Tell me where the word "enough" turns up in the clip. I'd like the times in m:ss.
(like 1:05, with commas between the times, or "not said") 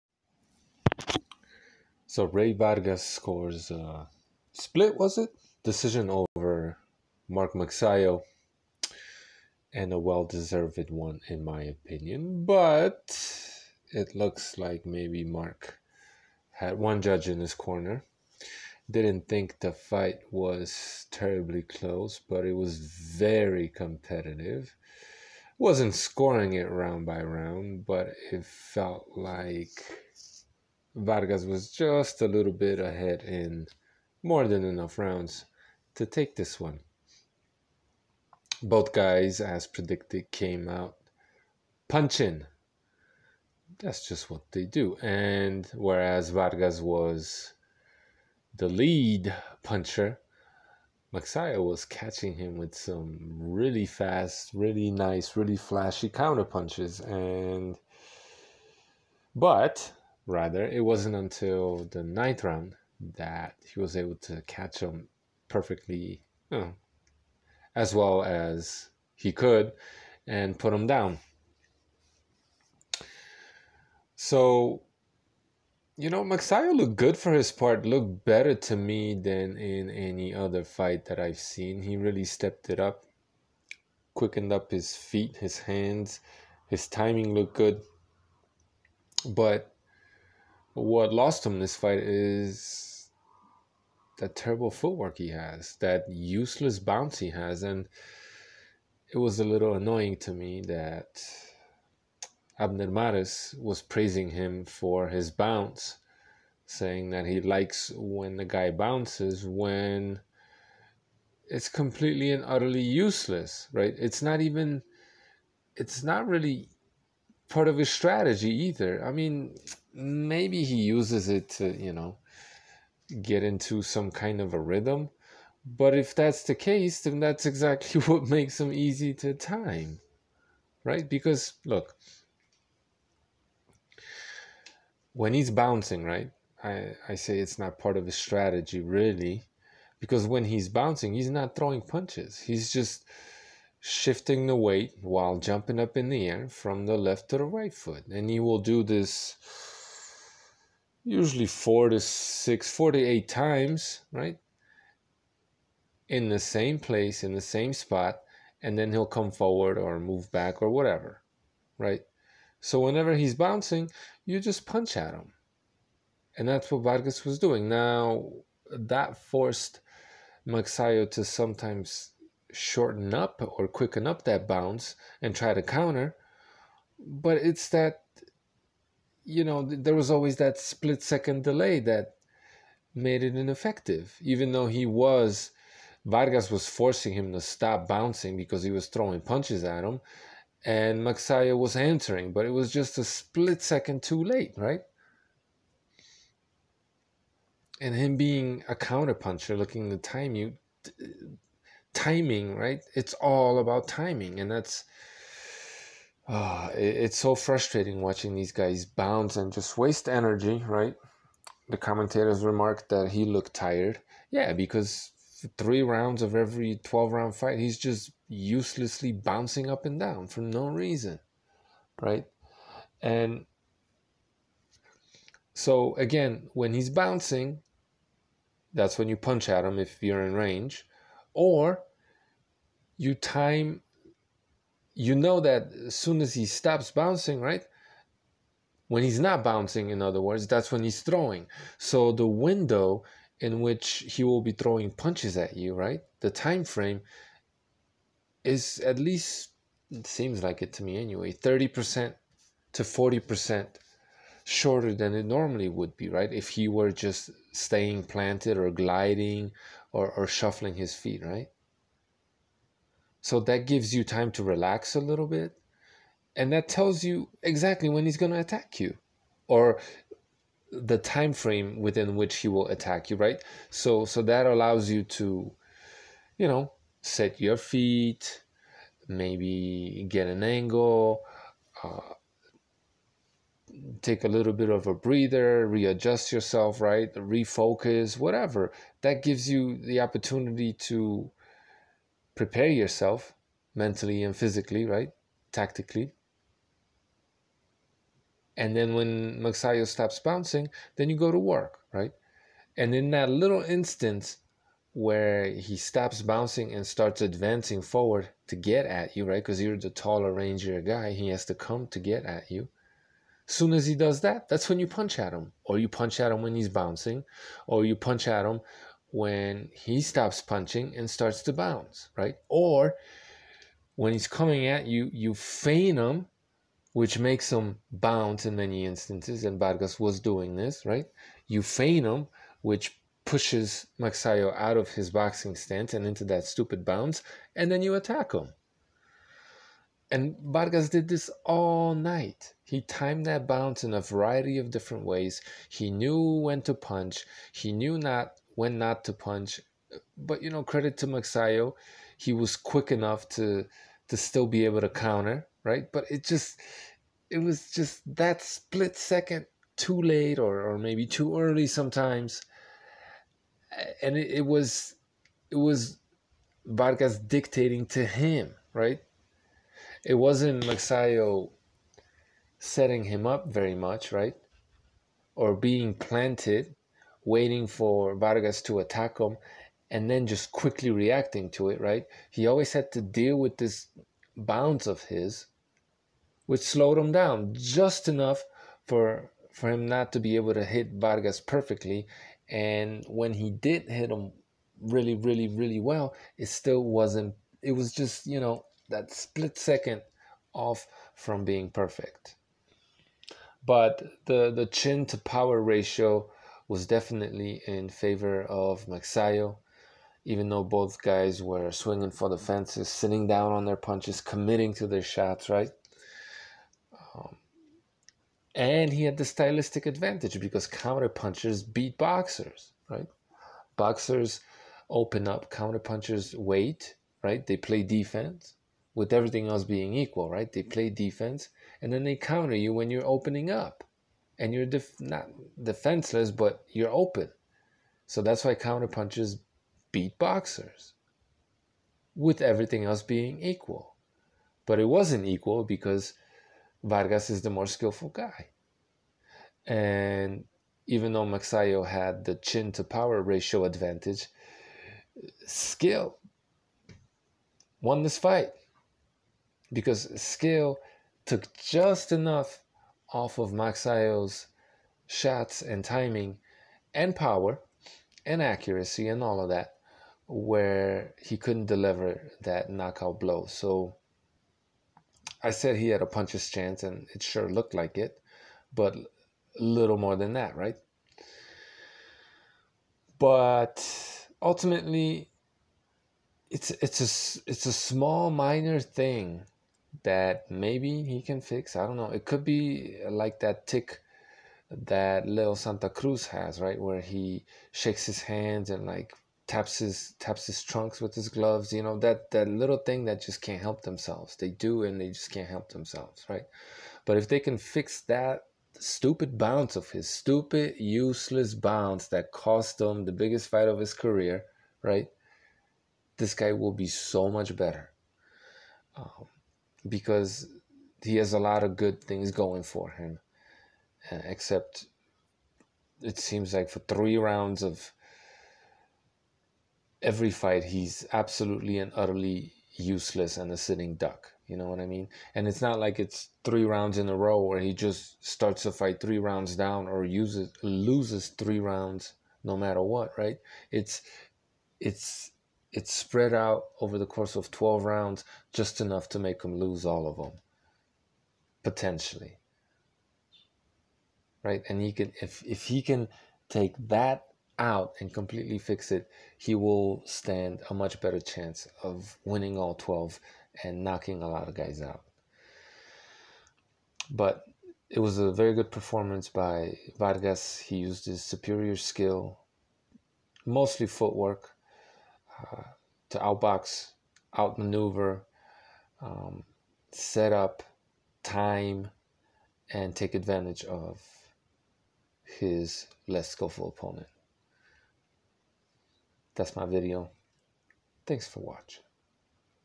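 0:34, 5:52, 6:28, 7:42, 9:08.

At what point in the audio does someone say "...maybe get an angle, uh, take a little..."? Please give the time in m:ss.
4:39.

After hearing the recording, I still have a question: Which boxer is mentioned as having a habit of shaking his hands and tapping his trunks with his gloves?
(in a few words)
Leo Santa Cruz.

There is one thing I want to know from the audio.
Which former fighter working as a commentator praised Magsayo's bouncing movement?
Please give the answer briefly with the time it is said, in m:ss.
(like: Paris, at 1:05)
Abner Mares, at 1:42.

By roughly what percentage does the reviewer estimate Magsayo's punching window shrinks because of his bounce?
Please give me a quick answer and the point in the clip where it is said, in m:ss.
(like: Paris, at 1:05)
30% to 40%, at 4:11.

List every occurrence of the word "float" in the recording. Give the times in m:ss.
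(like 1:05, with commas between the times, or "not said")
not said.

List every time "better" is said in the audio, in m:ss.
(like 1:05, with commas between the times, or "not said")
1:18, 8:37, 9:21.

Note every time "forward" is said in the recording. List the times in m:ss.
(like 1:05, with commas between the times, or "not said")
2:39, 5:07.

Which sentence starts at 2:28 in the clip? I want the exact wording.
And you will do this usually four to six, four to eight times, right?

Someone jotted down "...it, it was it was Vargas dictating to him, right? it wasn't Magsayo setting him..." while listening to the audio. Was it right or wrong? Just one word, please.
right.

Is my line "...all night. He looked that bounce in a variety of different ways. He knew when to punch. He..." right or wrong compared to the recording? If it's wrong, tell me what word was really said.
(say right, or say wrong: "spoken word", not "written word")
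wrong: "timed", not "looked".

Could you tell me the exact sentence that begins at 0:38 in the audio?
Both guys, as predicted, came out punching.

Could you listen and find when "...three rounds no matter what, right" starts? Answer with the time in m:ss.
9:01.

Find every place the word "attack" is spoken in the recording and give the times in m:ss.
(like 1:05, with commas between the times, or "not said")
4:28, 4:32, 5:37, 6:18.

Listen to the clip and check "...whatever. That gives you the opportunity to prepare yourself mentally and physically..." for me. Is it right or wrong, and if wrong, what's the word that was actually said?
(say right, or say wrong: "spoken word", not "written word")
right.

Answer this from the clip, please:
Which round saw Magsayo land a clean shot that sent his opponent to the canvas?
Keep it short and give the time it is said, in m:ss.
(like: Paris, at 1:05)
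ninth, at 1:02.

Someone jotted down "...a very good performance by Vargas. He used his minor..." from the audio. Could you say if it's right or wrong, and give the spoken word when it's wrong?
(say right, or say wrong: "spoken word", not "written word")
wrong: "superior", not "minor".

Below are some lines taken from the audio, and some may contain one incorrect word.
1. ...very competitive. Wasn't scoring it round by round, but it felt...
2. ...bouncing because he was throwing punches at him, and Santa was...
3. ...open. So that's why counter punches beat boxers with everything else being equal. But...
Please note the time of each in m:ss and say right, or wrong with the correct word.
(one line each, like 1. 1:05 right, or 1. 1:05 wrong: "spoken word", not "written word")
1. 0:22 right
2. 3:07 wrong: "Magsayo", not "Santa"
3. 7:16 right.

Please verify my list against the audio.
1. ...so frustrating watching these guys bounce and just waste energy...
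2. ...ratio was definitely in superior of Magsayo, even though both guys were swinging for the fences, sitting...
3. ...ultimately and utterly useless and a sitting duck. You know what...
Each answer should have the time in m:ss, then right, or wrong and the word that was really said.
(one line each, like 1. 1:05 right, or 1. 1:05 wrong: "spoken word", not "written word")
1. 3:27 right
2. 6:45 wrong: "favor", not "superior"
3. 8:51 wrong: "absolutely", not "ultimately".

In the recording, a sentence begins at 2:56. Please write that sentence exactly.
But it's that, you know, there was always that split second delay that made it ineffective, even though he was.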